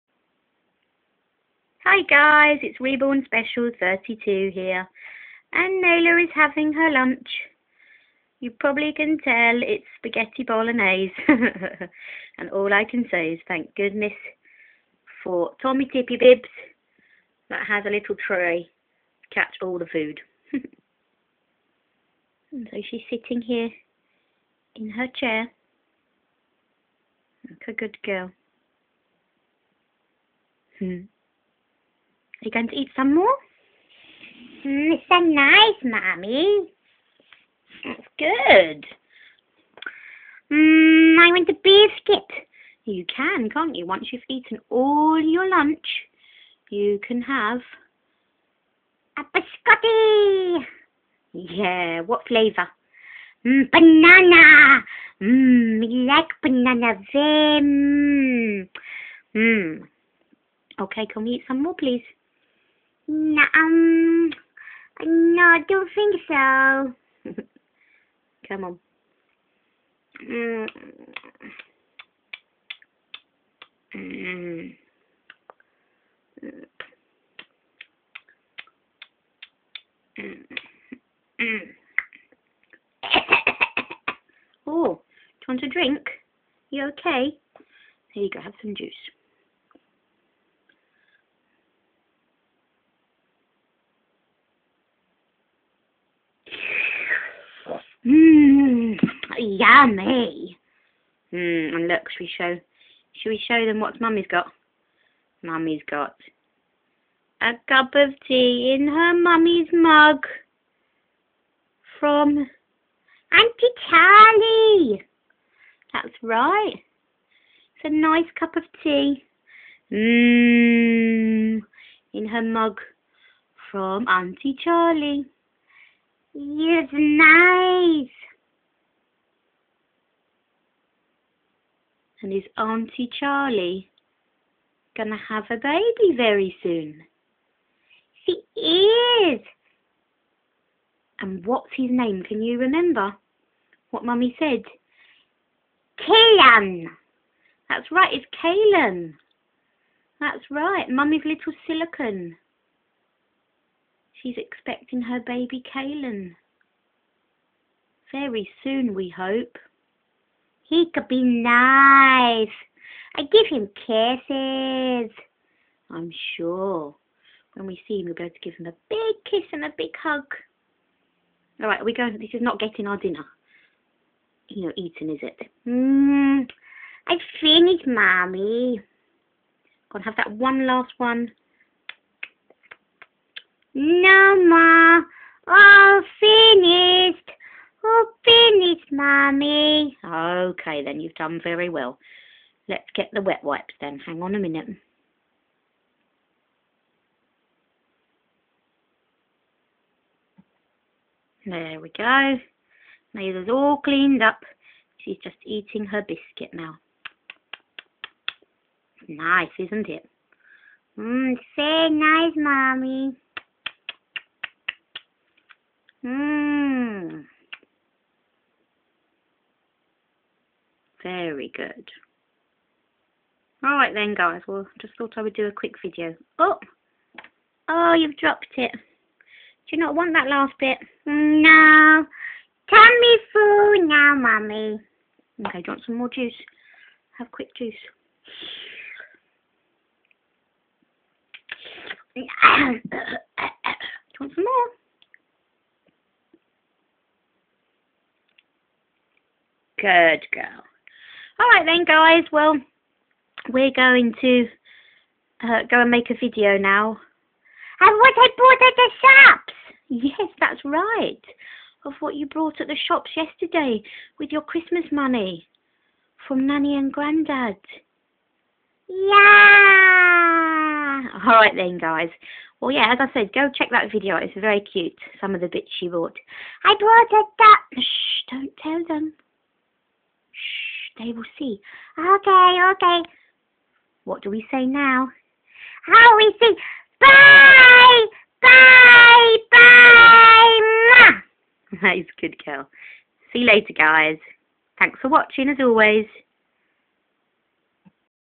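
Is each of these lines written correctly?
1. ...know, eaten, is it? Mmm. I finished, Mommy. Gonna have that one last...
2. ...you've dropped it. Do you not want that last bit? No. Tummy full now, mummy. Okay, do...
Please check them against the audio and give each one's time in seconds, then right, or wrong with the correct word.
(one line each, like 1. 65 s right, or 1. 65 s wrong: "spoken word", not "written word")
1. 174 s right
2. 227 s right.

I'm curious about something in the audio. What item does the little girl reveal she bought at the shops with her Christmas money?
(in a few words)
A duck.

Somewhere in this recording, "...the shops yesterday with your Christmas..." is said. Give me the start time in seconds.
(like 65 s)
262 s.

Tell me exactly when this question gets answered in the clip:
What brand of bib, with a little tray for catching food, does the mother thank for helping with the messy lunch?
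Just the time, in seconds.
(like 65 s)
15 s.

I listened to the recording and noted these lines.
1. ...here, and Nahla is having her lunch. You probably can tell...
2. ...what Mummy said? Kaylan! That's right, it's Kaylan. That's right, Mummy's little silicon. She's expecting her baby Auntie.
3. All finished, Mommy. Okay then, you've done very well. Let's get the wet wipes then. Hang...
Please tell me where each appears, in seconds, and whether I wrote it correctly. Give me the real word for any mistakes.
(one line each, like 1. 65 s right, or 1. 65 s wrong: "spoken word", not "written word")
1. 4 s right
2. 143 s wrong: "Kaylan", not "Auntie"
3. 187 s right.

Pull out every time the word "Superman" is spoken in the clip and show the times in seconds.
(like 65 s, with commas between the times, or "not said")
not said.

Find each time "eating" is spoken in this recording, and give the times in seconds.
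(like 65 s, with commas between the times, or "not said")
205 s.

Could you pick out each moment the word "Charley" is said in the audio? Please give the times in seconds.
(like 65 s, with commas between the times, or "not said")
113 s, 124 s, 133 s.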